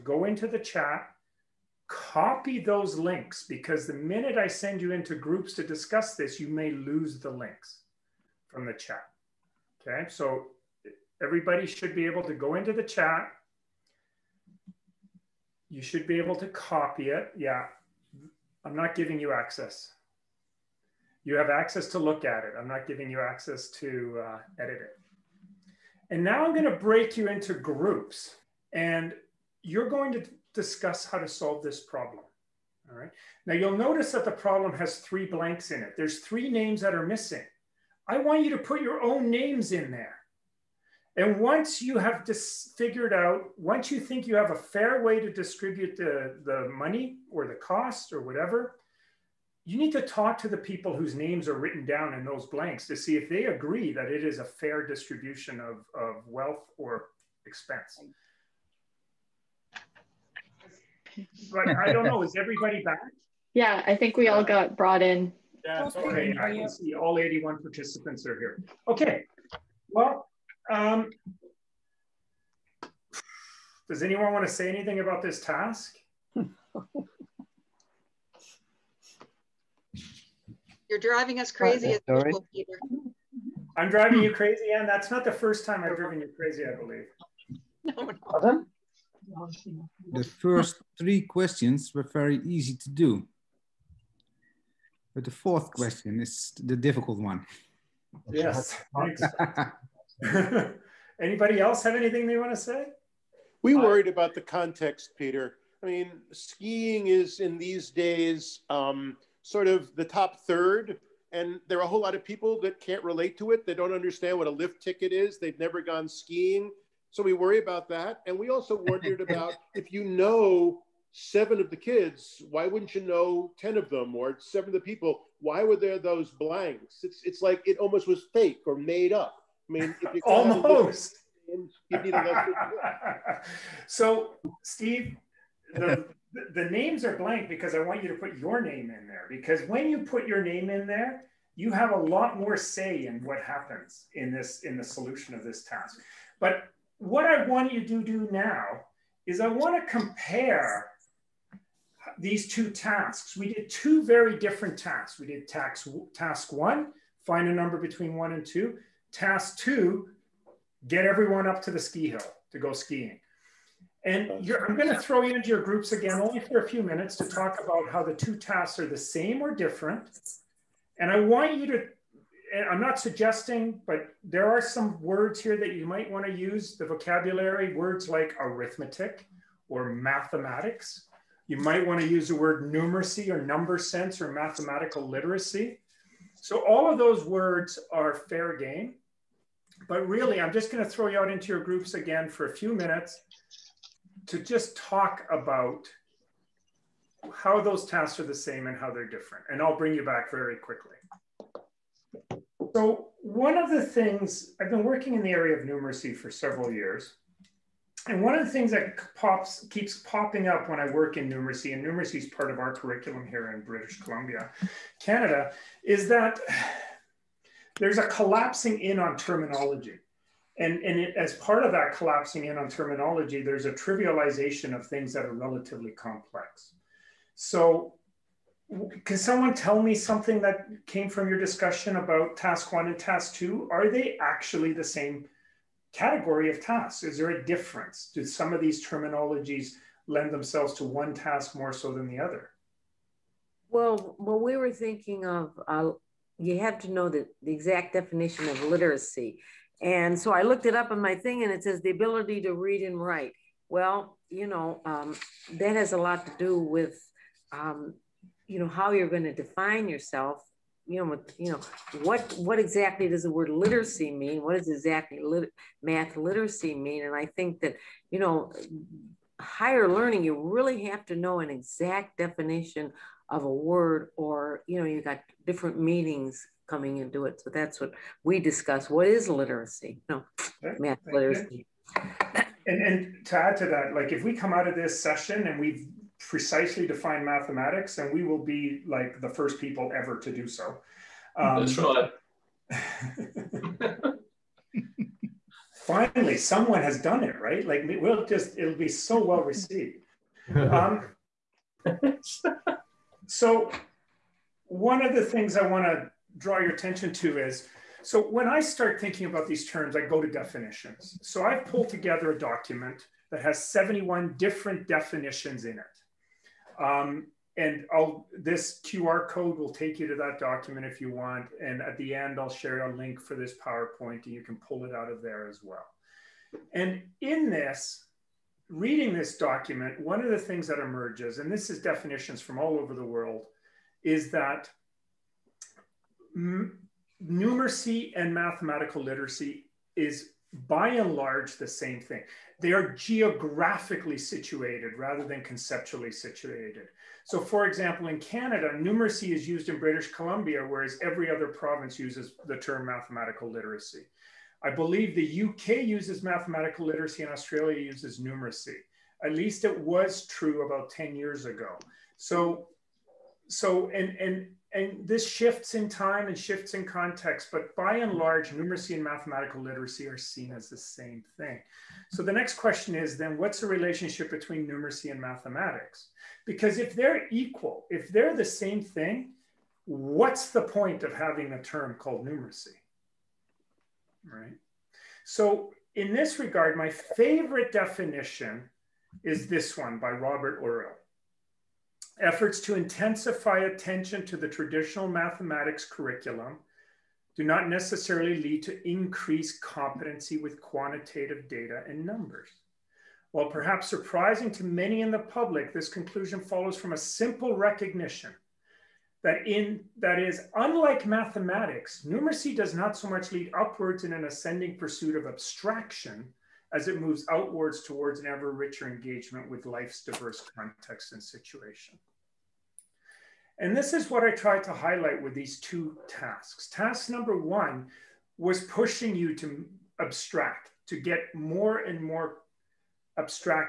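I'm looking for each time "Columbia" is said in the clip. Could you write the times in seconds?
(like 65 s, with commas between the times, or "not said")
213 s, 350 s.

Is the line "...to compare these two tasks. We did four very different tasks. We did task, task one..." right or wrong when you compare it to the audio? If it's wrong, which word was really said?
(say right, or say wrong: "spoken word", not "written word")
wrong: "two", not "four".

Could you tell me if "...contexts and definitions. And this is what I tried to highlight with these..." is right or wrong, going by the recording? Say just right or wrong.
wrong.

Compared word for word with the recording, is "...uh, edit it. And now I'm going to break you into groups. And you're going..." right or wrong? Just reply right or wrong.
right.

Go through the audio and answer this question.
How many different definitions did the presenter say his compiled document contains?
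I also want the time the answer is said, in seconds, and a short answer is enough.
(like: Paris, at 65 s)
71, at 313 s.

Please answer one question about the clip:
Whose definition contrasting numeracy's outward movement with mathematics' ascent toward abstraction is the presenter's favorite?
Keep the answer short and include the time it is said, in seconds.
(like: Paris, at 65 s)
Robert Orrill, at 390 s.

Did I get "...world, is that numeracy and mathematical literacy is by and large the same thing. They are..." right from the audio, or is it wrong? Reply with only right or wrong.
right.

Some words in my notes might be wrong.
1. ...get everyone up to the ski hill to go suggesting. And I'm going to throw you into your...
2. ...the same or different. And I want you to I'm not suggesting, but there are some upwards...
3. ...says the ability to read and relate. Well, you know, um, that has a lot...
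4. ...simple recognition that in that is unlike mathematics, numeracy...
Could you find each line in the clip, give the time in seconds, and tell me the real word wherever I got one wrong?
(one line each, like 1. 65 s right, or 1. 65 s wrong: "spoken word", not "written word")
1. 160 s wrong: "skiing", not "suggesting"
2. 168 s wrong: "words", not "upwards"
3. 251 s wrong: "write", not "relate"
4. 406 s right.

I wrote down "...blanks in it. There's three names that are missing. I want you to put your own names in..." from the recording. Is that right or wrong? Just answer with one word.
right.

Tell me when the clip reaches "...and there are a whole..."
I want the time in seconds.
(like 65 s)
111 s.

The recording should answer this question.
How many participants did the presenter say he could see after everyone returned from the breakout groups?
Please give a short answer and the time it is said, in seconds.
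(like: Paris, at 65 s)
81, at 67 s.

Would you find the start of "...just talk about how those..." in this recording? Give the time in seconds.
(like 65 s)
194 s.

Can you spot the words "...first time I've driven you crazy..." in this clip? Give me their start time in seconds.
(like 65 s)
85 s.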